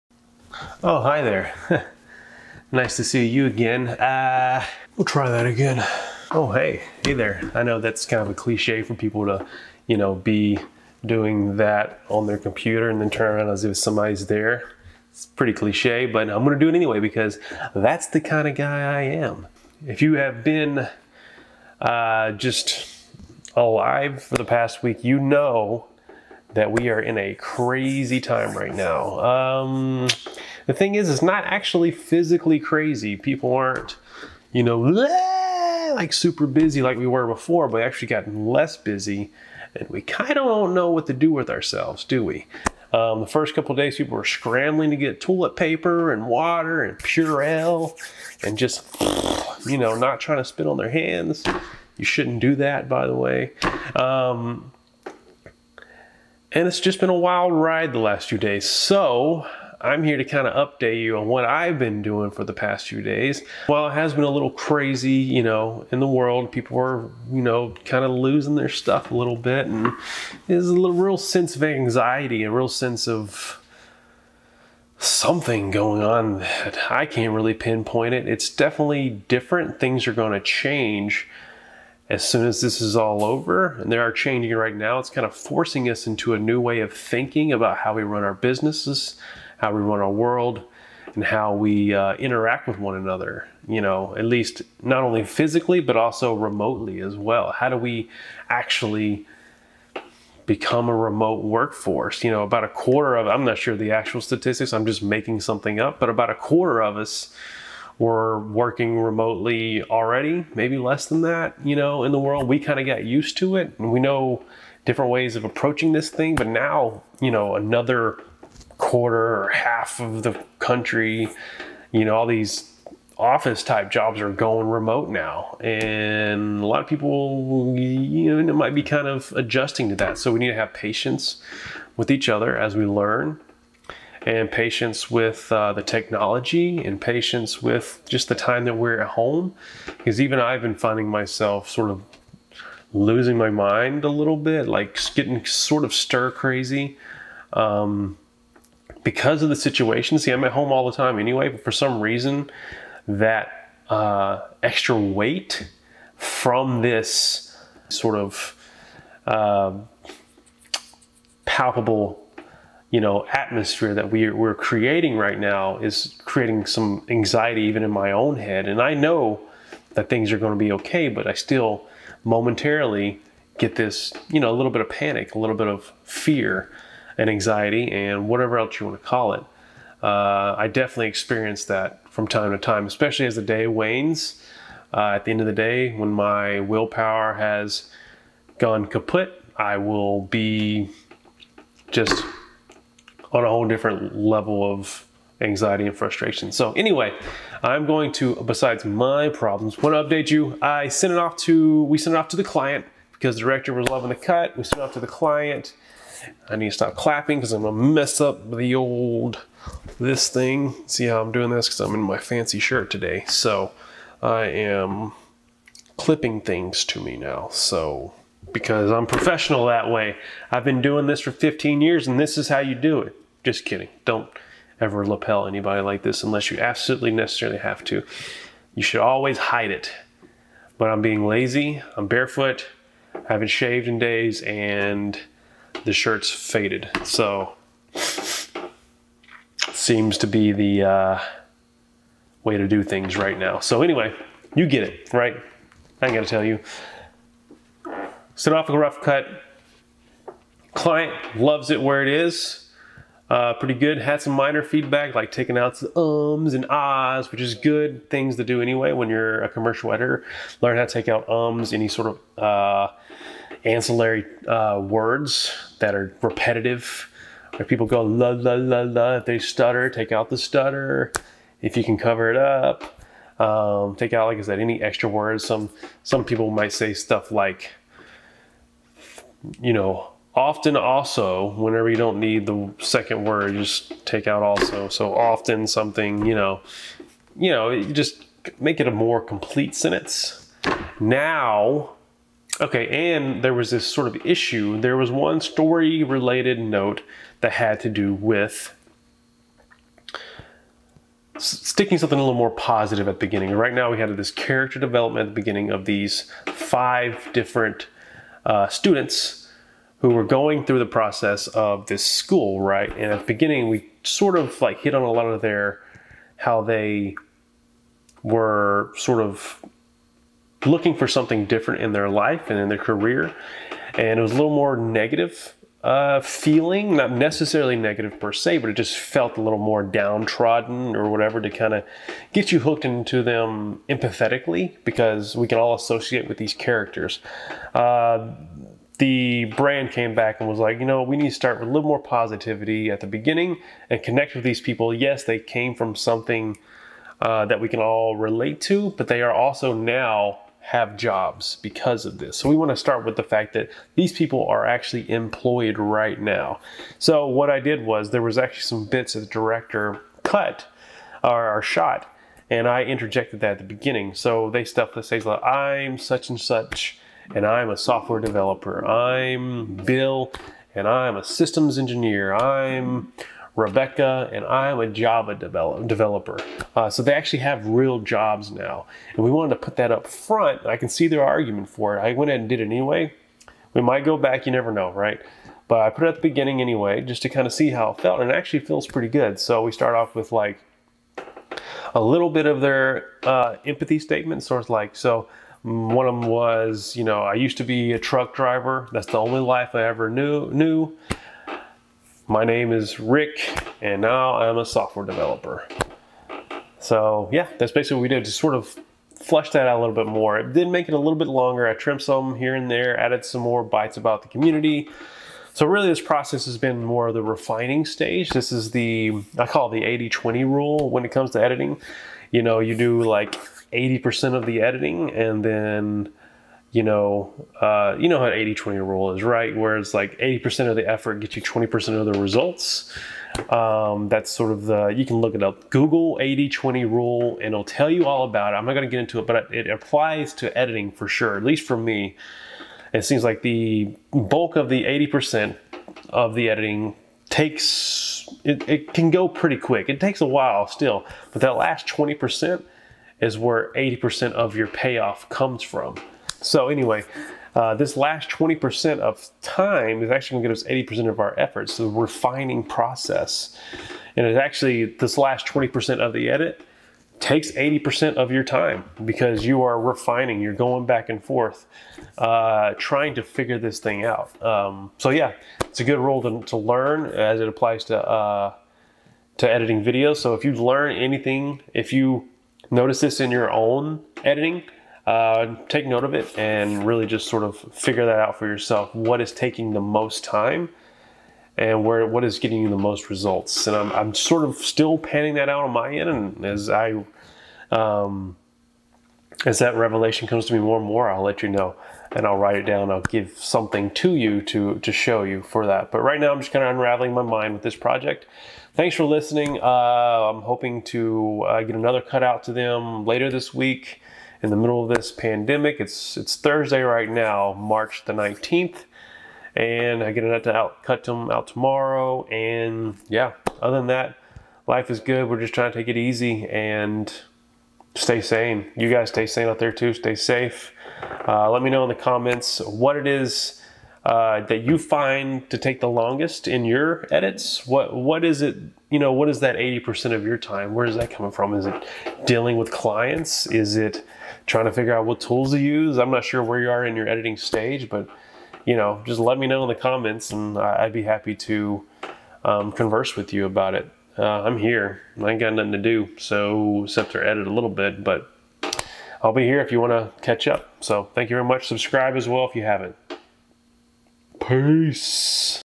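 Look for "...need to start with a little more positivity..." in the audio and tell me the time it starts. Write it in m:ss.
5:41.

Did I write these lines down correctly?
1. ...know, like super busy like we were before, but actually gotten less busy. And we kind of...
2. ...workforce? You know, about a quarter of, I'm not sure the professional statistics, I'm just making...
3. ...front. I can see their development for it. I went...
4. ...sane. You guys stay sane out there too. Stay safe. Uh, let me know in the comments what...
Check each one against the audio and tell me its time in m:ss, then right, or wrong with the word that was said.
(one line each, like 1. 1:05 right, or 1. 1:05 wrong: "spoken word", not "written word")
1. 0:34 right
2. 1:41 wrong: "actual", not "professional"
3. 6:20 wrong: "argument", not "development"
4. 8:48 right.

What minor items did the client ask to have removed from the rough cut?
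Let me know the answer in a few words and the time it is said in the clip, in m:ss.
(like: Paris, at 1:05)
ums and ahs, at 4:15.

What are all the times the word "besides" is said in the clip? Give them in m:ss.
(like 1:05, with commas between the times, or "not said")
3:18.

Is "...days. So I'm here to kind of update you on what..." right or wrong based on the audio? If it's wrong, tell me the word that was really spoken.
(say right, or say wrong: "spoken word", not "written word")
right.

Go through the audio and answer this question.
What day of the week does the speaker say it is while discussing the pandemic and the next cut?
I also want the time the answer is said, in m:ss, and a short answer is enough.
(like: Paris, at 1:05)
Thursday, at 8:36.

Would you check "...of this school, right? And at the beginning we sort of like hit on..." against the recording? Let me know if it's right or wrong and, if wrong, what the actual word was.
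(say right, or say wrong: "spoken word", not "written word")
right.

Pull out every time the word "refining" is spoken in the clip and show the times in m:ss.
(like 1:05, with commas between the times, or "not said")
6:57, 7:41, 7:49.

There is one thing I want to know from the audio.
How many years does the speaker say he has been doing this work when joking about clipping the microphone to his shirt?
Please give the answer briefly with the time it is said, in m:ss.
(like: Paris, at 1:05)
15 years, at 3:41.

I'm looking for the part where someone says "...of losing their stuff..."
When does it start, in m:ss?
1:08.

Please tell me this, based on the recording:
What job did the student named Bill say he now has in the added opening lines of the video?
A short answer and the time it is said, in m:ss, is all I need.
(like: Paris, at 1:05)
systems engineer, at 6:11.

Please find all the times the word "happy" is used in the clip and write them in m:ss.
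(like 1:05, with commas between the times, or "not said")
9:11.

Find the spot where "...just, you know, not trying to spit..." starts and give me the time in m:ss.
0:48.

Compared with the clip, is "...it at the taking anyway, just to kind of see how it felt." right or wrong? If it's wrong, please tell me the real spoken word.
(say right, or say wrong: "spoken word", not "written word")
wrong: "beginning", not "taking".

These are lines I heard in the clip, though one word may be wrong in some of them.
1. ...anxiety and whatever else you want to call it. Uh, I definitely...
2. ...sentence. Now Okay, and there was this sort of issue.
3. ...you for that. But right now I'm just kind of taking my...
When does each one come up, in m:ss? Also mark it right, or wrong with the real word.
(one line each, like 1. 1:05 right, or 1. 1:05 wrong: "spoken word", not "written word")
1. 2:57 right
2. 4:49 right
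3. 8:25 wrong: "unraveling", not "taking".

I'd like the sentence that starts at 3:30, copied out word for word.
See how I'm doing this because I'm in my fancy shirt today.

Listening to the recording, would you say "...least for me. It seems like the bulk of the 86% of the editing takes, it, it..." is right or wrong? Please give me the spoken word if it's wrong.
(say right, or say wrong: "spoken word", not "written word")
wrong: "80", not "86".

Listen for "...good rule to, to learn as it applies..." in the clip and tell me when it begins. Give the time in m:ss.
7:55.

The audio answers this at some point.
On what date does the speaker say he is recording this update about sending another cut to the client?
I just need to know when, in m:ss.
8:37.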